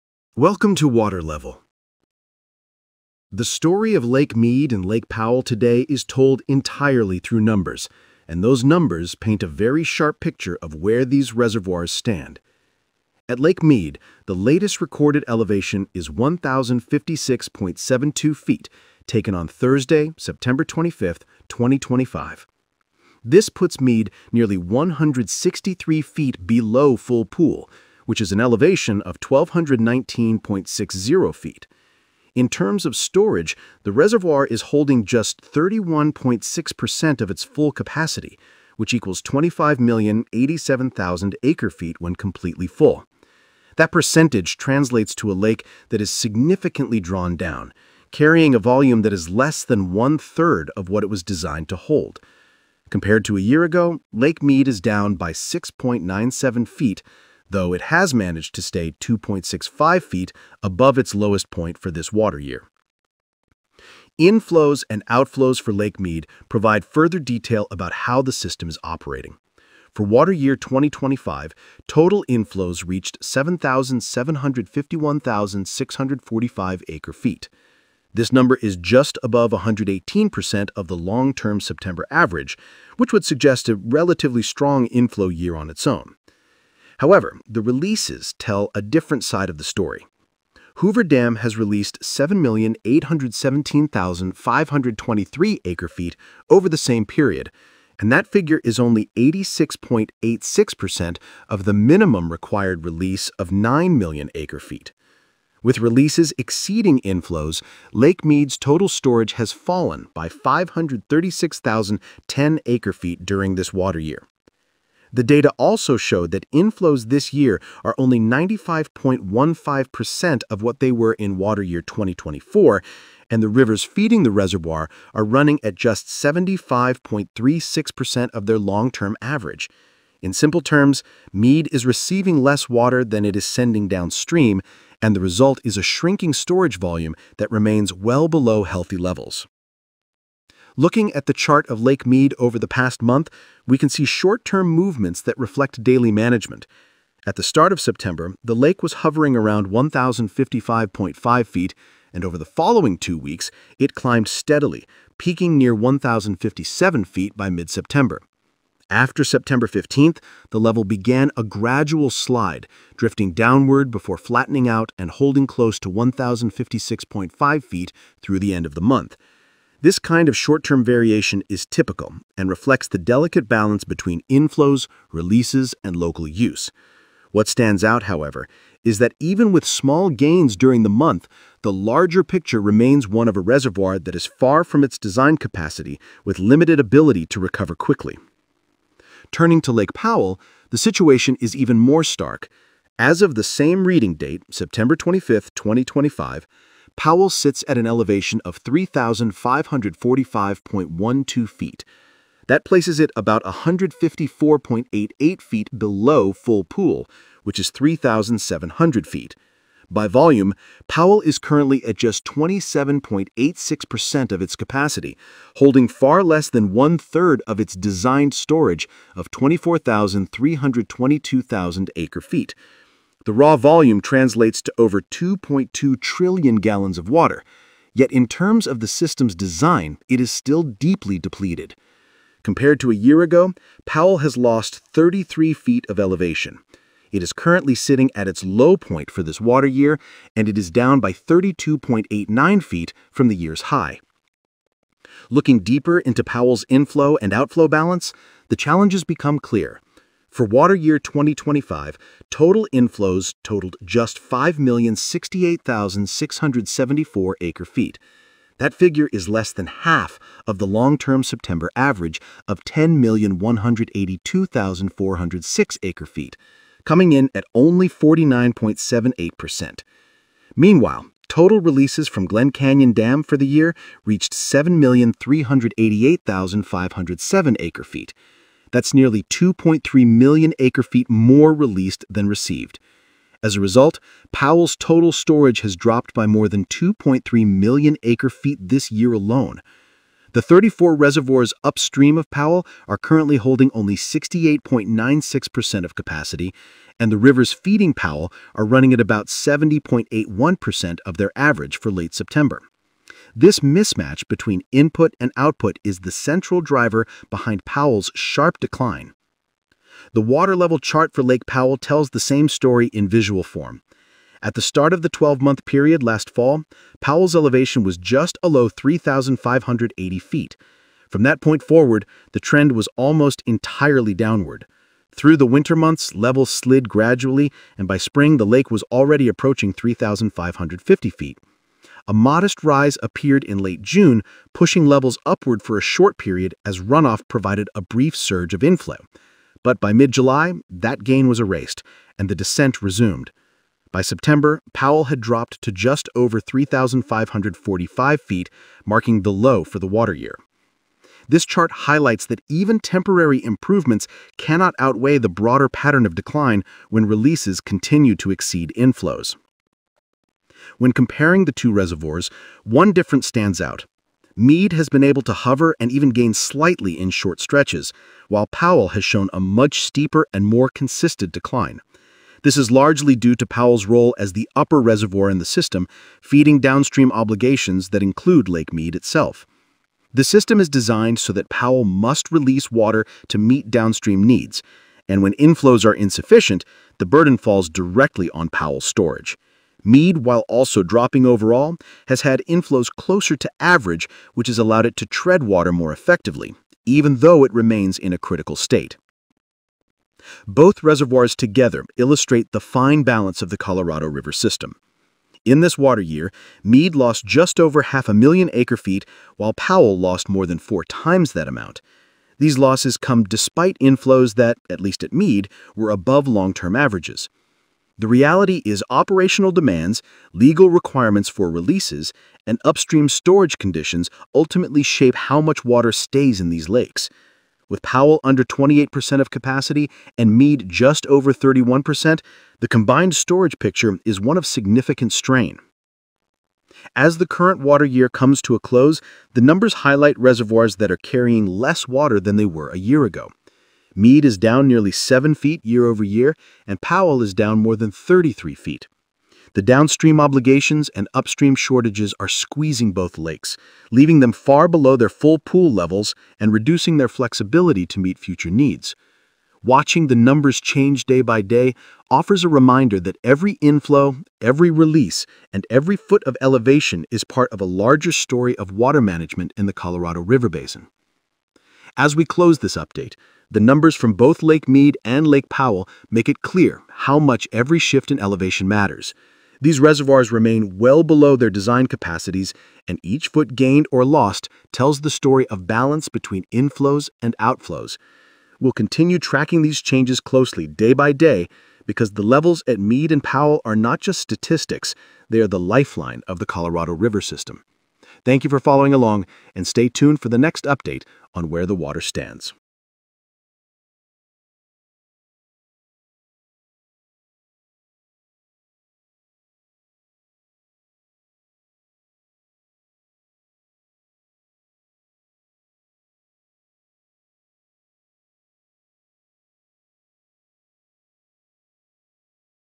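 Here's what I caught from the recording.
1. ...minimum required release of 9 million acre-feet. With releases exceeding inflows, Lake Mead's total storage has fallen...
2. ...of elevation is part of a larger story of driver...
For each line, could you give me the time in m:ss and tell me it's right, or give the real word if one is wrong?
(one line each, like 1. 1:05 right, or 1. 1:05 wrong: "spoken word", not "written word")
1. 1:41 right
2. 7:46 wrong: "water", not "driver".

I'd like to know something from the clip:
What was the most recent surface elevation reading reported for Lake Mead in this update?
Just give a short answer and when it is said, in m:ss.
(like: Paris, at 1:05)
1,056.72 feet, at 0:16.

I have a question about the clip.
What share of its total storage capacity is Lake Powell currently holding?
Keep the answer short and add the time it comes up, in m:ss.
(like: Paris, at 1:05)
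27.86%, at 3:32.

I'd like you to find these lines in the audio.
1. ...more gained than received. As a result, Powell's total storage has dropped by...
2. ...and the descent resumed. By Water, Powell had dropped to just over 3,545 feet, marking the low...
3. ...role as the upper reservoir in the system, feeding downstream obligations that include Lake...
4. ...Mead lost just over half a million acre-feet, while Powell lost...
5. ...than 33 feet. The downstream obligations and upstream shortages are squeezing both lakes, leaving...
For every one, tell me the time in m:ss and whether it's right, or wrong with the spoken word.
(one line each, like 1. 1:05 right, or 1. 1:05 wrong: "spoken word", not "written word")
1. 4:41 wrong: "released", not "gained"
2. 5:42 wrong: "September", not "Water"
3. 6:13 right
4. 6:46 right
5. 7:27 right.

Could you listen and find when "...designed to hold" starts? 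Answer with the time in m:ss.
0:51.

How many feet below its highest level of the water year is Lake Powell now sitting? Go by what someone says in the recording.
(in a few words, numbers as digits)
32.89 feet.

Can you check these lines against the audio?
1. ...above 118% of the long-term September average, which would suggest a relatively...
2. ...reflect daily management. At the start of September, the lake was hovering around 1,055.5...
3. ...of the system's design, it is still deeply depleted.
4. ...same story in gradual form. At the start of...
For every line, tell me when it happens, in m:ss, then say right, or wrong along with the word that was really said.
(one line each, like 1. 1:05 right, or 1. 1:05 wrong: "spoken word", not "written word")
1. 1:19 right
2. 2:25 right
3. 3:48 right
4. 5:12 wrong: "visual", not "gradual".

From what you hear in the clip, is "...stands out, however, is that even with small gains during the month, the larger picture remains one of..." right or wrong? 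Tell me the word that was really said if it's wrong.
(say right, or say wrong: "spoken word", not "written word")
right.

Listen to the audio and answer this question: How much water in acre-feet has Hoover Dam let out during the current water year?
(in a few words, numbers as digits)
7,817,523 acre-feet.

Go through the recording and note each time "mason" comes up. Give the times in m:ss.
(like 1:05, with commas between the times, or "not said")
not said.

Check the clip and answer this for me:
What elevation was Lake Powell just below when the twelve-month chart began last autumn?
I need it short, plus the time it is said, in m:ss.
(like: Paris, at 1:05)
3,580 feet, at 5:18.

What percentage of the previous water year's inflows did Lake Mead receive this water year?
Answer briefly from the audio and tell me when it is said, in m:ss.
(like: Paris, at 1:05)
95.15%, at 1:58.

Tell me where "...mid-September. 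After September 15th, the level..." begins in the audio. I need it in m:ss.
2:37.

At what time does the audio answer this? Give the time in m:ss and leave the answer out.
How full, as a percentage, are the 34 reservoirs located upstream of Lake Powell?
4:53.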